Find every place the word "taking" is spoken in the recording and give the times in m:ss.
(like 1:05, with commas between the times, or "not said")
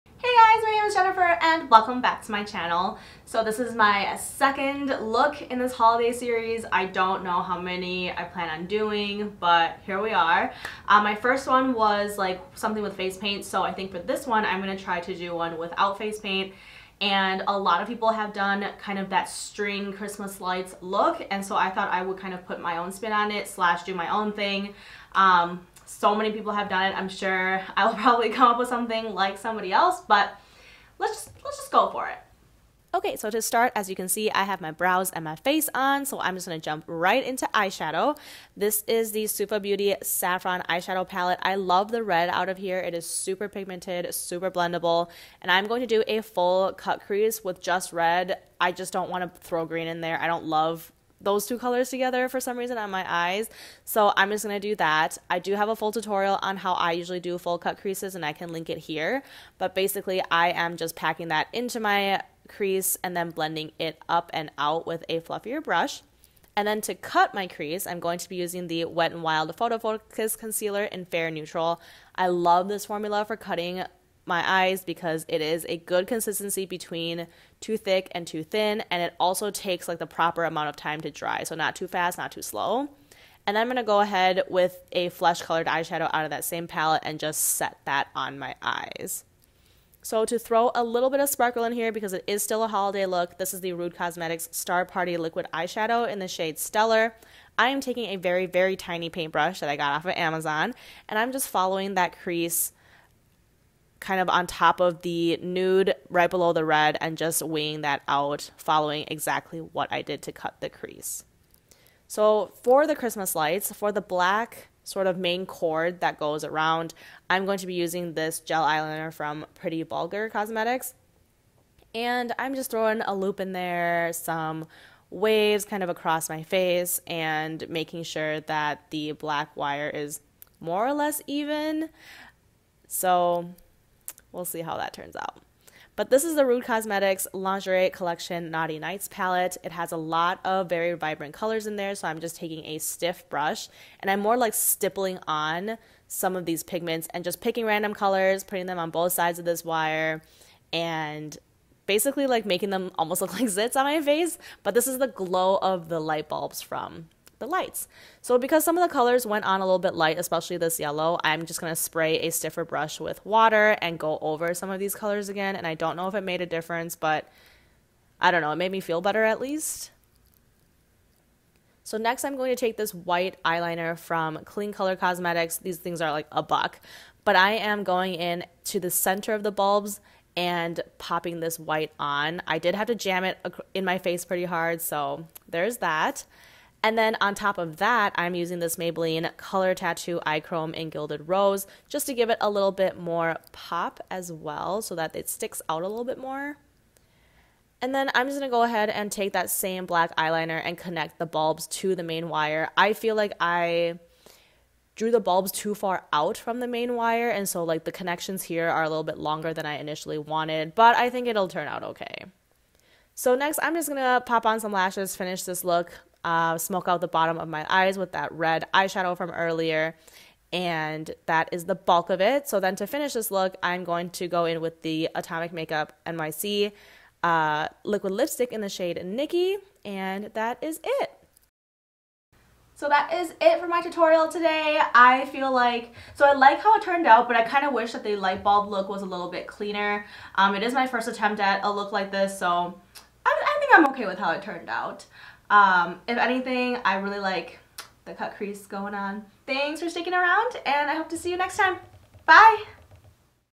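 1:37, 2:22.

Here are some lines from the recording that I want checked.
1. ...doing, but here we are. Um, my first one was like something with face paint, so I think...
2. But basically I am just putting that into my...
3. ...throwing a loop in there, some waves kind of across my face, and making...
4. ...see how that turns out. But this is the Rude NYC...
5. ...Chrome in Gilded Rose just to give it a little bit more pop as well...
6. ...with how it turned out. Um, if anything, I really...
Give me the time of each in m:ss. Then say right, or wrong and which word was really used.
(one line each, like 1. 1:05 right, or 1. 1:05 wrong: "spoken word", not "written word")
1. 0:08 right
2. 0:59 wrong: "packing", not "putting"
3. 2:02 right
4. 2:14 wrong: "Cosmetics", not "NYC"
5. 3:10 right
6. 4:04 right.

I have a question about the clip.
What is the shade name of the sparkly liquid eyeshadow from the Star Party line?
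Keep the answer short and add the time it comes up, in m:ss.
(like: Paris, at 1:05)
Stellar, at 1:36.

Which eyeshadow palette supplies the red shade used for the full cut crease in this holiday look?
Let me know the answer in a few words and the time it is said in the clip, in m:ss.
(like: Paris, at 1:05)
Suva Beauty Saffron, at 0:39.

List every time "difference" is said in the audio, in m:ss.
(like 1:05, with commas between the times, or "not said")
2:46.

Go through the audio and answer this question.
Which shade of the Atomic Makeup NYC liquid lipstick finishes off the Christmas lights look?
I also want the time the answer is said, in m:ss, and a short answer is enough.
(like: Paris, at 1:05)
Nikki, at 3:49.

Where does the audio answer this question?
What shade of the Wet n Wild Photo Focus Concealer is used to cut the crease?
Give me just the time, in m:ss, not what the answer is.
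1:11.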